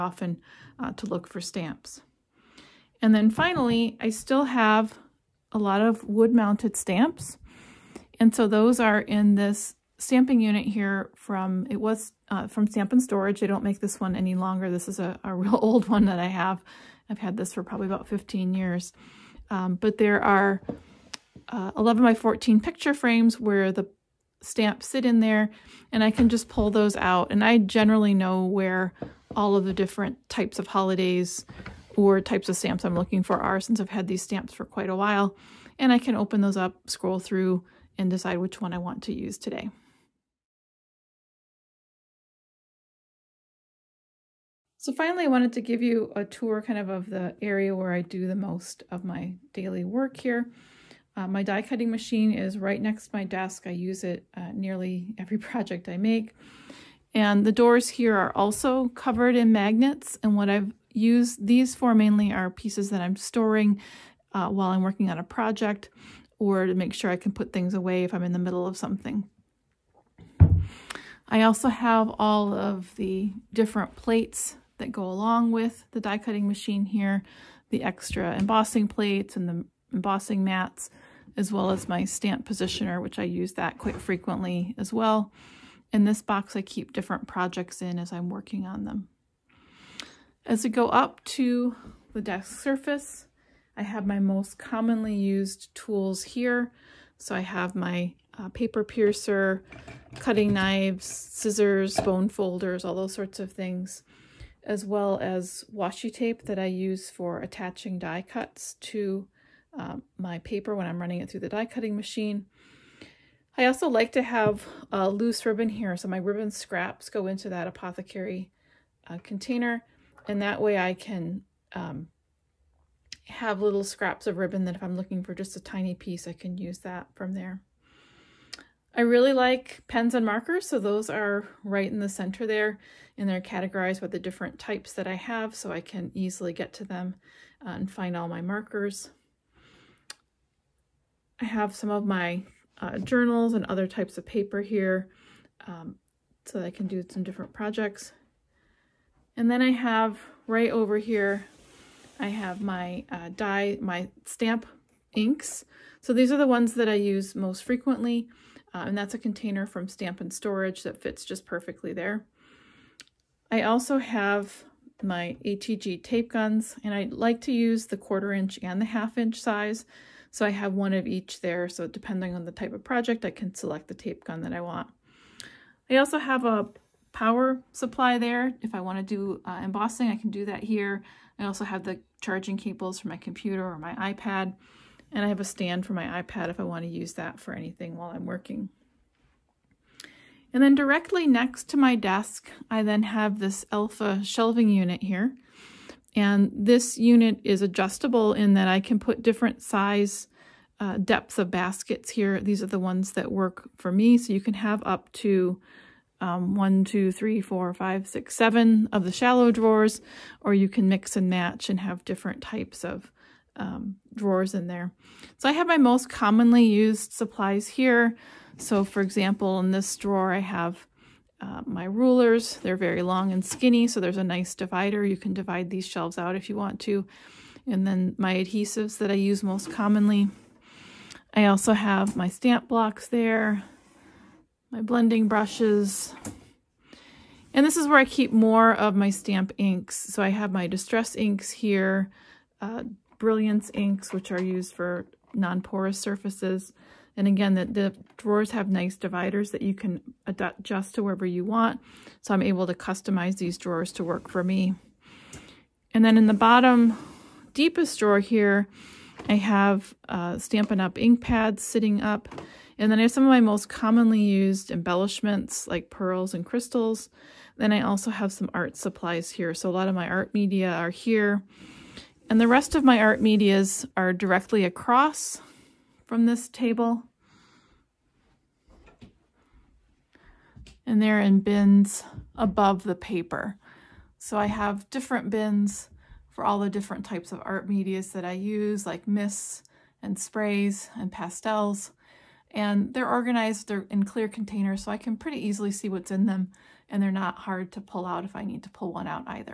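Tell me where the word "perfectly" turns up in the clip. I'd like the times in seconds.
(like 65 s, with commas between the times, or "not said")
161 s.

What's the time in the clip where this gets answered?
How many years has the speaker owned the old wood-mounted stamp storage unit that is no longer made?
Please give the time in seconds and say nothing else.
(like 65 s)
18 s.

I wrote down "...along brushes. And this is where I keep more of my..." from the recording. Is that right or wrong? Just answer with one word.
wrong.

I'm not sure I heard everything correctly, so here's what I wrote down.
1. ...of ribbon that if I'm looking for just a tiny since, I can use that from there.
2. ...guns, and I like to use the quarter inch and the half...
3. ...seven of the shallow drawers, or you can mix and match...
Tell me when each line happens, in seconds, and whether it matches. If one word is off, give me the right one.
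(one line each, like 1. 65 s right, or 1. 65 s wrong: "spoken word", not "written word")
1. 124 s wrong: "piece", not "since"
2. 166 s right
3. 208 s right.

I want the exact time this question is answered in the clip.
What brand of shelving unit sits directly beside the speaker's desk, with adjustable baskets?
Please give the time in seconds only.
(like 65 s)
193 s.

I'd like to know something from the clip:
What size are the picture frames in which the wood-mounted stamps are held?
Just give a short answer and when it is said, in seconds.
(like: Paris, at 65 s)
11 by 14, at 21 s.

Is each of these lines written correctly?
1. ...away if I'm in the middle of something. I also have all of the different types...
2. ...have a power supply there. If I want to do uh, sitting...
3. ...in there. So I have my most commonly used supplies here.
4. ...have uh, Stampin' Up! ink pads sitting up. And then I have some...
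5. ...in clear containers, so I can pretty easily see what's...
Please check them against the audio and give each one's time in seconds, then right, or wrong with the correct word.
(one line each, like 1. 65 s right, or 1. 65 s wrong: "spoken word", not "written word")
1. 67 s wrong: "plates", not "types"
2. 176 s wrong: "embossing", not "sitting"
3. 214 s right
4. 259 s right
5. 293 s right.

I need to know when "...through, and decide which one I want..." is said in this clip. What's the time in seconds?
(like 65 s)
37 s.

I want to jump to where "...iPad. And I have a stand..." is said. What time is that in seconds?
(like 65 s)
183 s.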